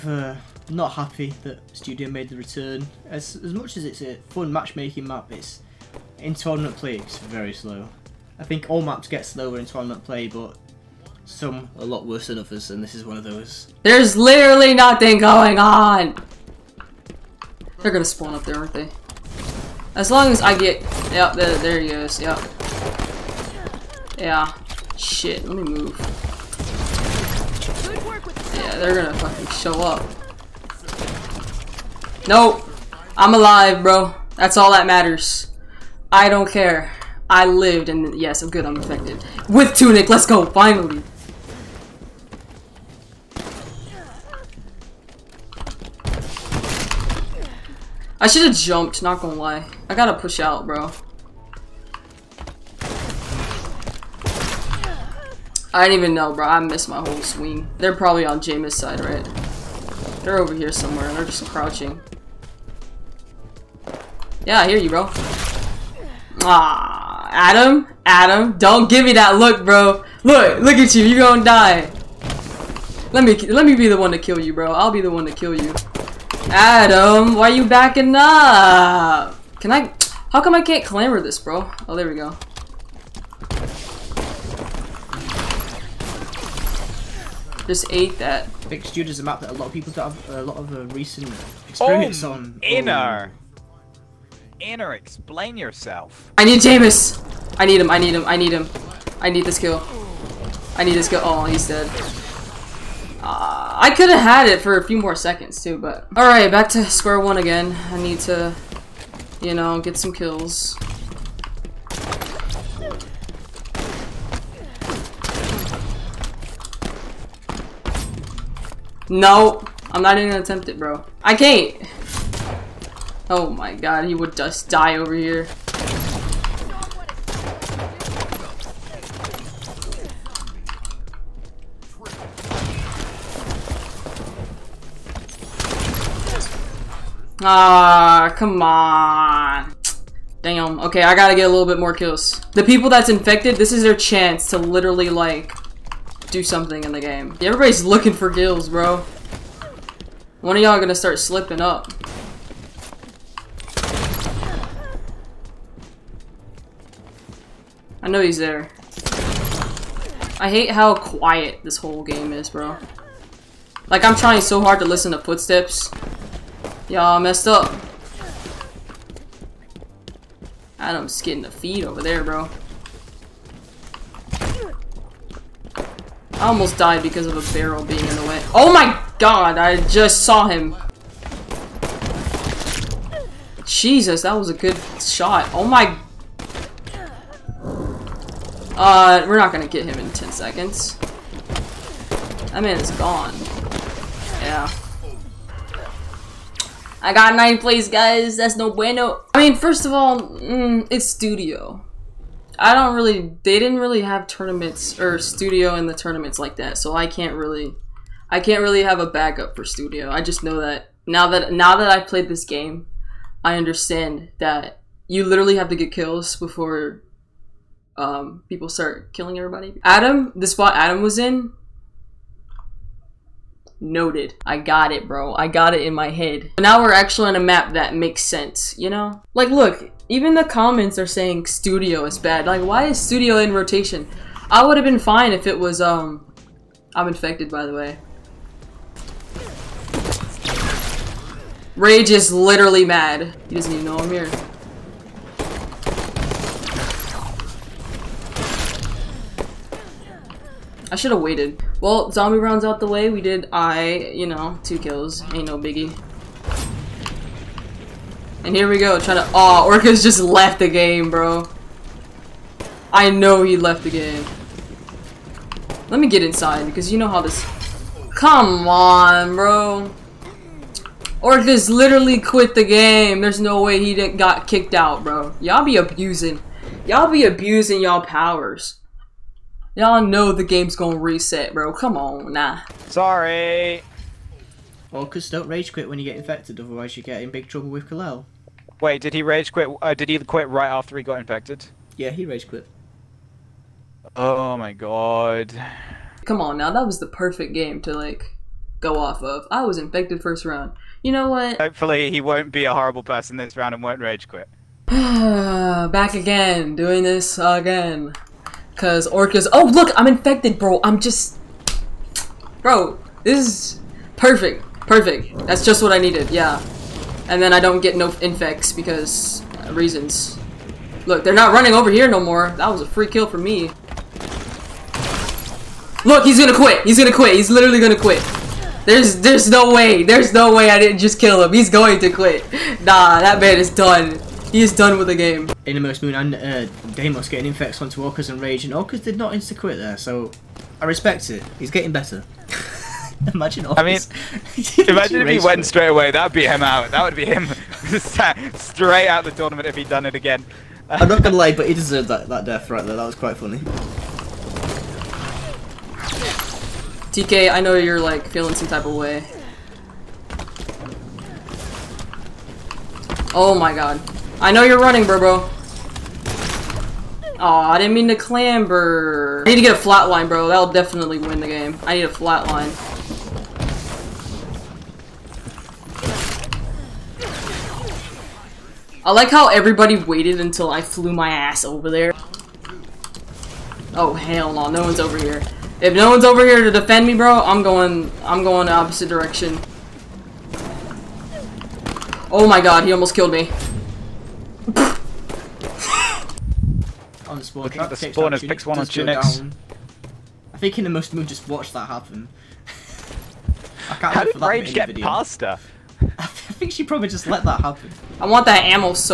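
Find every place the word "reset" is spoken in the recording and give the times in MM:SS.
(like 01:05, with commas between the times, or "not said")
04:40.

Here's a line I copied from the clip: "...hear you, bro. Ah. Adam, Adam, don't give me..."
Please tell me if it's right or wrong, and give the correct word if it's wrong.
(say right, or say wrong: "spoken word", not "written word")
right.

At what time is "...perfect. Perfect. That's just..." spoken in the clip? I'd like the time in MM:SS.
05:14.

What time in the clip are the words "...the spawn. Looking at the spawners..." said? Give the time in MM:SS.
06:37.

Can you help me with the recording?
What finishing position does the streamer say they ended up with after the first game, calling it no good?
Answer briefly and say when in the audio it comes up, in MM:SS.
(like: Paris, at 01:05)
ninth place, at 03:17.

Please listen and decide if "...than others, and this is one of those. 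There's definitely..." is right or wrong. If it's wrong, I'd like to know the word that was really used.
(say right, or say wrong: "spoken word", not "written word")
wrong: "literally", not "definitely".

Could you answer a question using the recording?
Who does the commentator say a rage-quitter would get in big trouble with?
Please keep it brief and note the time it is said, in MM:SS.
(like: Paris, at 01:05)
Kalel, at 04:47.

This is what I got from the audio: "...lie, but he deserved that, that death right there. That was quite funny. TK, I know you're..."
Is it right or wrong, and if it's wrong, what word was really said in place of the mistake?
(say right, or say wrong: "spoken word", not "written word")
right.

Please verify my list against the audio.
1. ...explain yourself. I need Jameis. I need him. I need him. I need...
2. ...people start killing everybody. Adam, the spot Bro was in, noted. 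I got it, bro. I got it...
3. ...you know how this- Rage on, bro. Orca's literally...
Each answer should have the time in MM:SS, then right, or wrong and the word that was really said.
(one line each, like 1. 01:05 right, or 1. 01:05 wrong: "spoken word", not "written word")
1. 01:34 right
2. 03:38 wrong: "Adam", not "Bro"
3. 04:26 wrong: "Come", not "Rage".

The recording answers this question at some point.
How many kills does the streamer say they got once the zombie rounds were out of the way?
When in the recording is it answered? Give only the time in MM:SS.
04:14.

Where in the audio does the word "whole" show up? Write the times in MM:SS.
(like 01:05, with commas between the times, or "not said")
00:56, 02:41.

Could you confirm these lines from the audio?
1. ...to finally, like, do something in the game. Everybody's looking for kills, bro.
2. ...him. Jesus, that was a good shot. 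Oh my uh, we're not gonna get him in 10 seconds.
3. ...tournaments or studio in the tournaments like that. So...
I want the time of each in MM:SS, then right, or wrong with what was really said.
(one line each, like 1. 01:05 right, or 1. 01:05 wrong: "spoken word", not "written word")
1. 02:24 wrong: "literally", not "finally"
2. 03:00 right
3. 03:24 right.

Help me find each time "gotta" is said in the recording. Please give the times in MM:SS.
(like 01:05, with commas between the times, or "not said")
00:49, 02:21.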